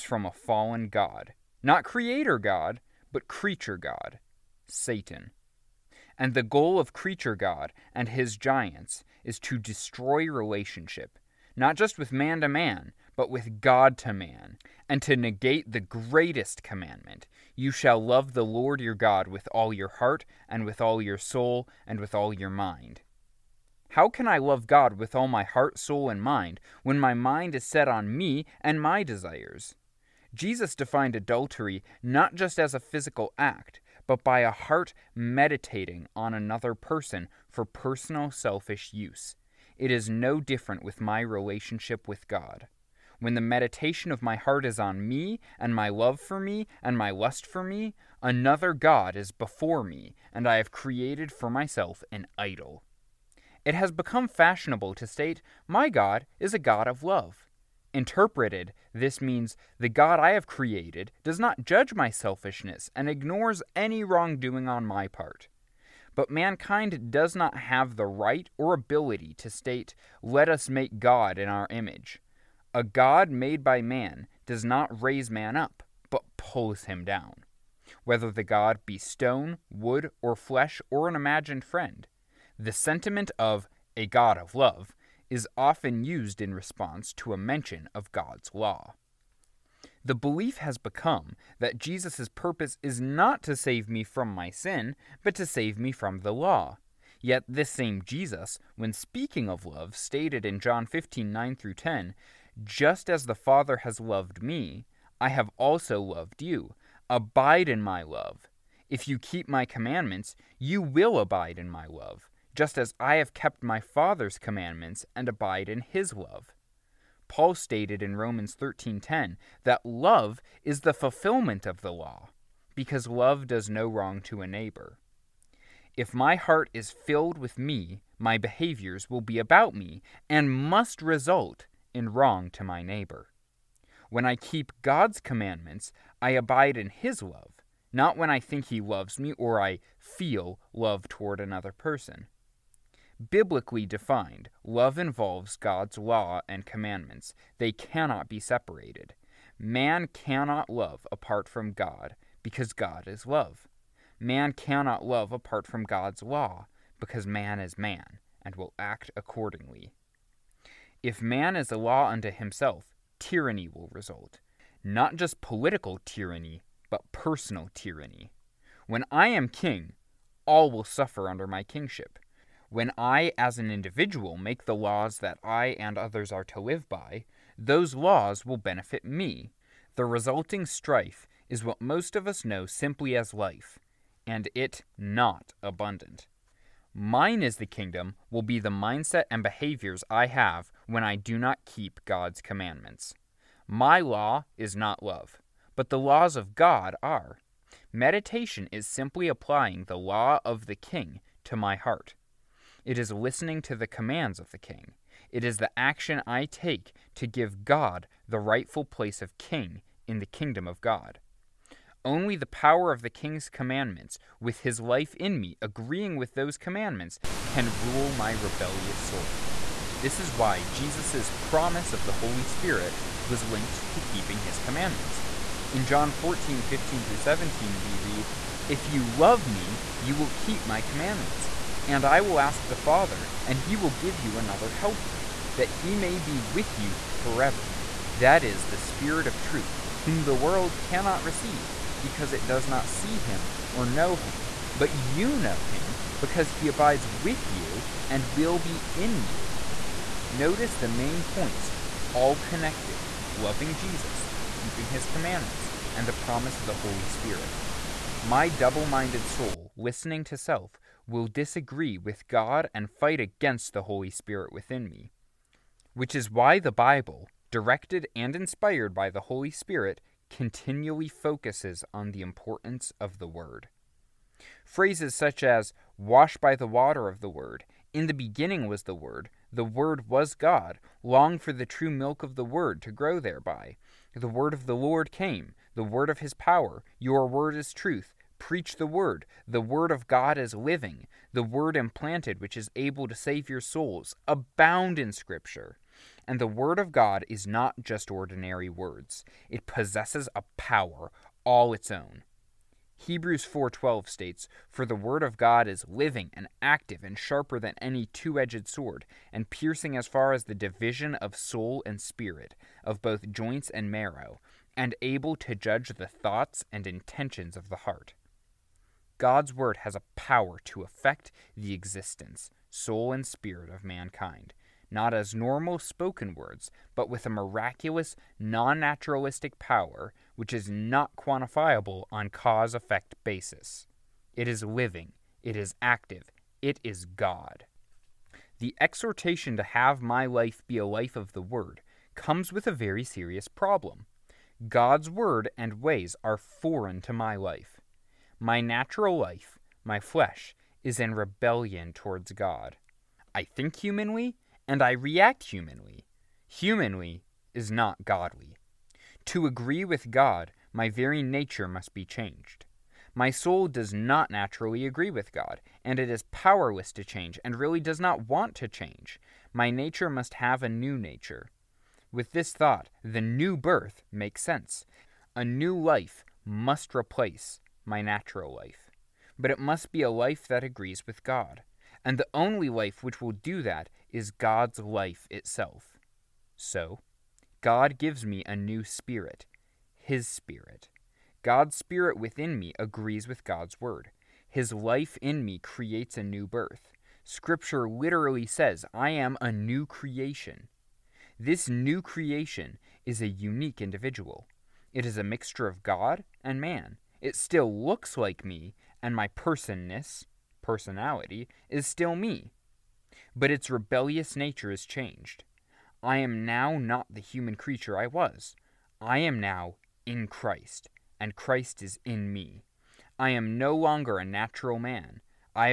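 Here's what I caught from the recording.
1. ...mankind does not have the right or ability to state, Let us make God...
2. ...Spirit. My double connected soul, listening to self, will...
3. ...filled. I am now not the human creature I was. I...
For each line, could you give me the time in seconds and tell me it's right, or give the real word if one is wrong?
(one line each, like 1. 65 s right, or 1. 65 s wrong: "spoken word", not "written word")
1. 66 s right
2. 257 s wrong: "minded", not "connected"
3. 414 s wrong: "changed", not "filled".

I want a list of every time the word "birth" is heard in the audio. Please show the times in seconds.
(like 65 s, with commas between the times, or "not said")
373 s, 396 s.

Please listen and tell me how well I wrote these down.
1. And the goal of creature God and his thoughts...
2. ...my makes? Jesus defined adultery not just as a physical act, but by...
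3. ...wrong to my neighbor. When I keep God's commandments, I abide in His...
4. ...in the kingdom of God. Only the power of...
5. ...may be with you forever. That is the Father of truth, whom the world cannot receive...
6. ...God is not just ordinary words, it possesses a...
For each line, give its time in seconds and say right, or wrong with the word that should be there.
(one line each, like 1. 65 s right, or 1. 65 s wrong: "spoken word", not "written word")
1. 6 s wrong: "giants", not "thoughts"
2. 28 s wrong: "desires", not "makes"
3. 132 s right
4. 210 s right
5. 235 s wrong: "Spirit", not "Father"
6. 296 s right.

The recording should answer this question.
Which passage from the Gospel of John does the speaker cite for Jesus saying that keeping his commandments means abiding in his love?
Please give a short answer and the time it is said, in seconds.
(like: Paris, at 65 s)
John 15:9-10, at 100 s.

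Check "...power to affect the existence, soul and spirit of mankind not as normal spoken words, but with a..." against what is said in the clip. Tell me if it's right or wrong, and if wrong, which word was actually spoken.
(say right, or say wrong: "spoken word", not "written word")
right.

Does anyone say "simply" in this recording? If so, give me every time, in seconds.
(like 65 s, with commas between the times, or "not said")
182 s, 198 s.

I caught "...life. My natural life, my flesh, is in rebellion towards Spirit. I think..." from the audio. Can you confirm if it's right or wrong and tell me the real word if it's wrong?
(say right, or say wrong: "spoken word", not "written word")
wrong: "God", not "Spirit".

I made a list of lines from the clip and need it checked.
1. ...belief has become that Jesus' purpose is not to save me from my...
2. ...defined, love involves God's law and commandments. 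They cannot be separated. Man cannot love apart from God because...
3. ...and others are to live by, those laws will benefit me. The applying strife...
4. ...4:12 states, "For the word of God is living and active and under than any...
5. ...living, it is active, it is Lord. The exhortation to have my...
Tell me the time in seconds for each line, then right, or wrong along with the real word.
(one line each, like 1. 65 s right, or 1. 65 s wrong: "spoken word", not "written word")
1. 90 s right
2. 143 s right
3. 175 s wrong: "resulting", not "applying"
4. 303 s wrong: "sharper", not "under"
5. 334 s wrong: "God", not "Lord".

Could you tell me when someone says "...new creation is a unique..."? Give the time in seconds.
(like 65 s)
401 s.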